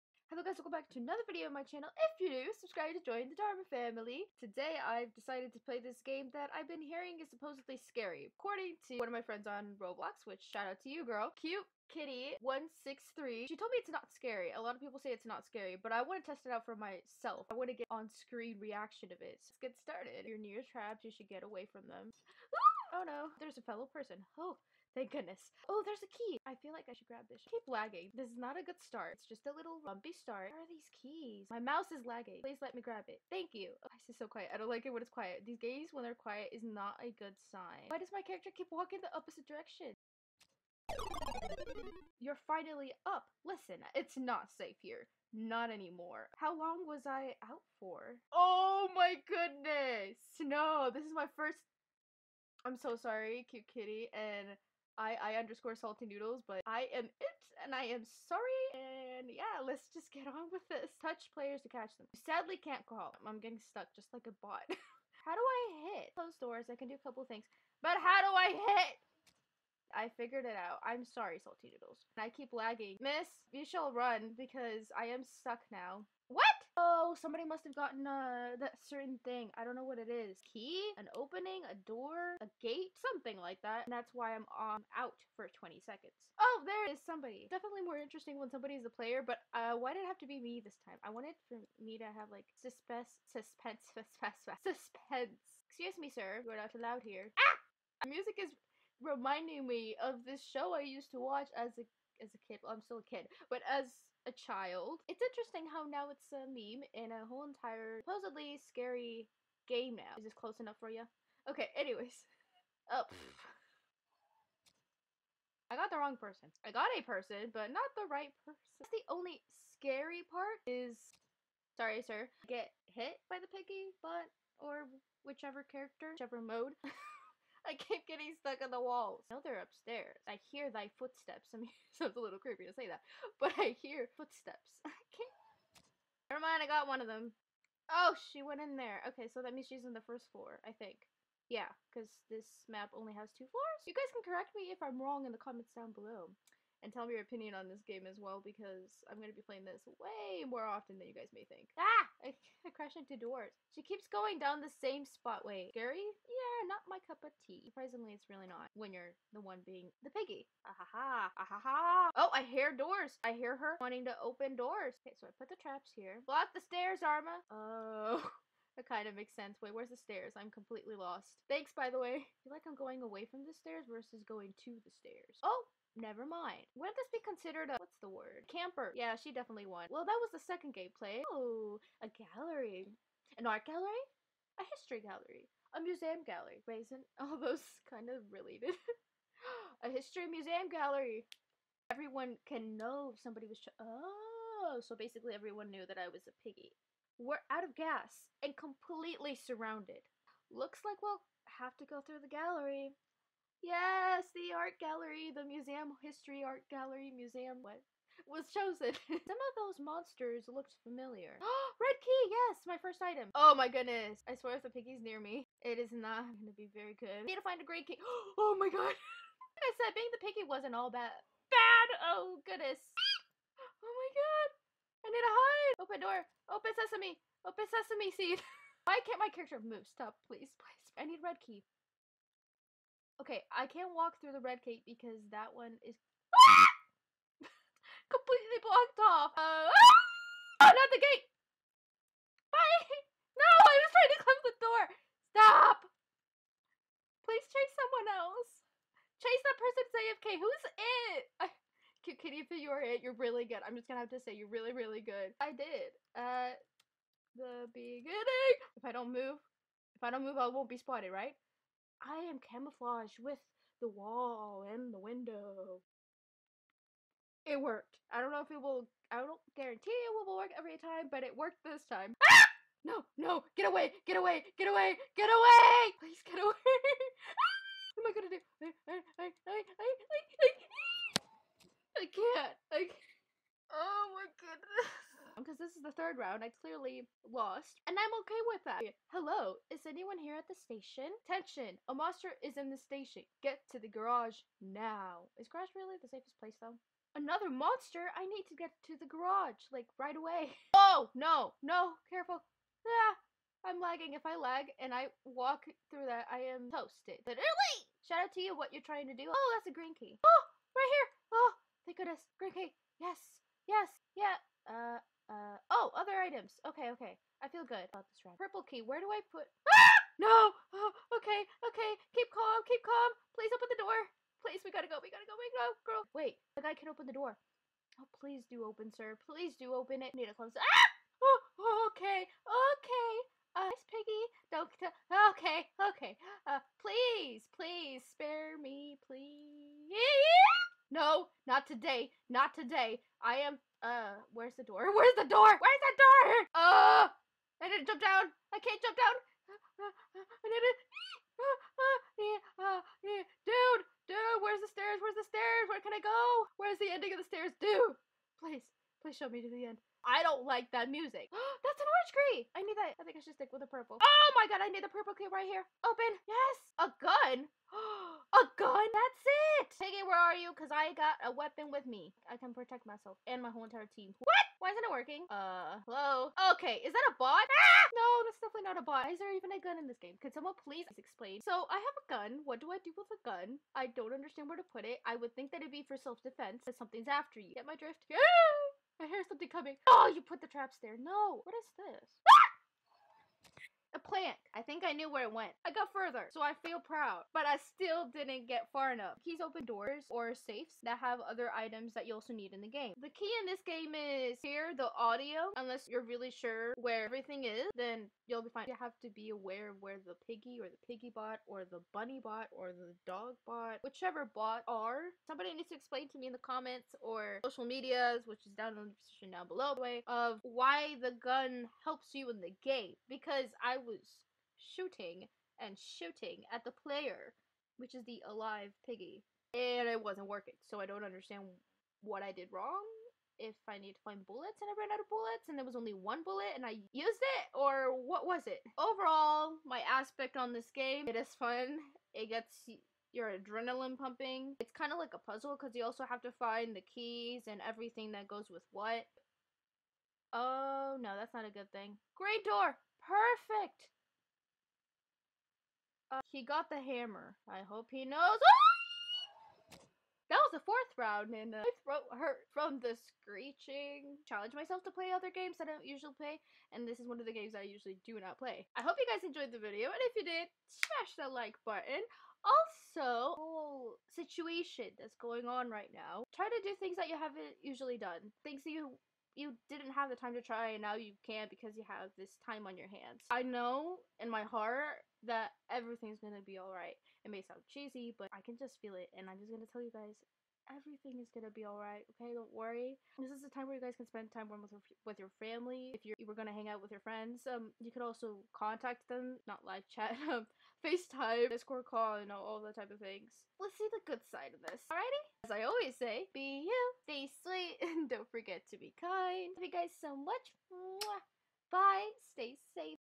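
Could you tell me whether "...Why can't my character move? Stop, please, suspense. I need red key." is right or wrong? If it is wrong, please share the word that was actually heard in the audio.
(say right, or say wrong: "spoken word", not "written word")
wrong: "please", not "suspense".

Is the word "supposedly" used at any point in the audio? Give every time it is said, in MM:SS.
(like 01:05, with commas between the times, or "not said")
00:07, 01:48.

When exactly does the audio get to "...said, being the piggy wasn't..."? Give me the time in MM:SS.
03:39.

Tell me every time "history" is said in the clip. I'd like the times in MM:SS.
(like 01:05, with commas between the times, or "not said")
03:04, 03:09, 03:26.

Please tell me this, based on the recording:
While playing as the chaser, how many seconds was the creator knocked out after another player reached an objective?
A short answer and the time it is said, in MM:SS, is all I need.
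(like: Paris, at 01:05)
20, at 01:25.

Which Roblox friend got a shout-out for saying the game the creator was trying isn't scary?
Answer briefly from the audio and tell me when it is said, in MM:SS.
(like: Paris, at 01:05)
Cute Kitty163, at 00:11.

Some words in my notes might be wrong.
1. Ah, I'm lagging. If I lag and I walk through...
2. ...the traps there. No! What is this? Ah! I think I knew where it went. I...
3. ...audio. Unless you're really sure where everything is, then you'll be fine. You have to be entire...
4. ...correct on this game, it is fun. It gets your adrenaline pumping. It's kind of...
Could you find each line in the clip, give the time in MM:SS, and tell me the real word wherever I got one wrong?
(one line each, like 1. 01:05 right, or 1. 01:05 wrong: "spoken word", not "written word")
1. 05:02 right
2. 06:30 right
3. 06:44 wrong: "aware", not "entire"
4. 07:19 wrong: "aspect", not "correct".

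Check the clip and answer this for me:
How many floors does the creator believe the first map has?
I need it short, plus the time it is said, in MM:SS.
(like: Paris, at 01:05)
2, at 02:23.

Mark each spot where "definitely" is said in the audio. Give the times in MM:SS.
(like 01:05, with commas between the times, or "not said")
01:27, 02:59, 06:18.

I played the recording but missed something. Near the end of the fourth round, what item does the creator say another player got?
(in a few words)
Hammer.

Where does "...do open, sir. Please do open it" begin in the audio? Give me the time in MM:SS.
05:28.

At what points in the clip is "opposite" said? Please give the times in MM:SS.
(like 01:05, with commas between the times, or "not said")
00:39.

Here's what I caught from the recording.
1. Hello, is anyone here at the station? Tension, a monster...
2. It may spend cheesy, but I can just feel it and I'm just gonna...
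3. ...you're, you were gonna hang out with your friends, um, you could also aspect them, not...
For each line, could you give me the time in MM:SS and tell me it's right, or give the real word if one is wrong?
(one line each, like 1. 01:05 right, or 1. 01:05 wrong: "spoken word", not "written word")
1. 04:49 right
2. 08:07 wrong: "sound", not "spend"
3. 08:16 wrong: "contact", not "aspect".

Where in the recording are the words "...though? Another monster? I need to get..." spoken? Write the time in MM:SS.
04:56.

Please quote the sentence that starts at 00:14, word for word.
A lot of people say it's not scary, but I want to test it out for myself.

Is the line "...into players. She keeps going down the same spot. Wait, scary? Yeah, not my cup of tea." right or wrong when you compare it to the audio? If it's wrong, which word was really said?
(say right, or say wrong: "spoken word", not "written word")
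wrong: "doors", not "players".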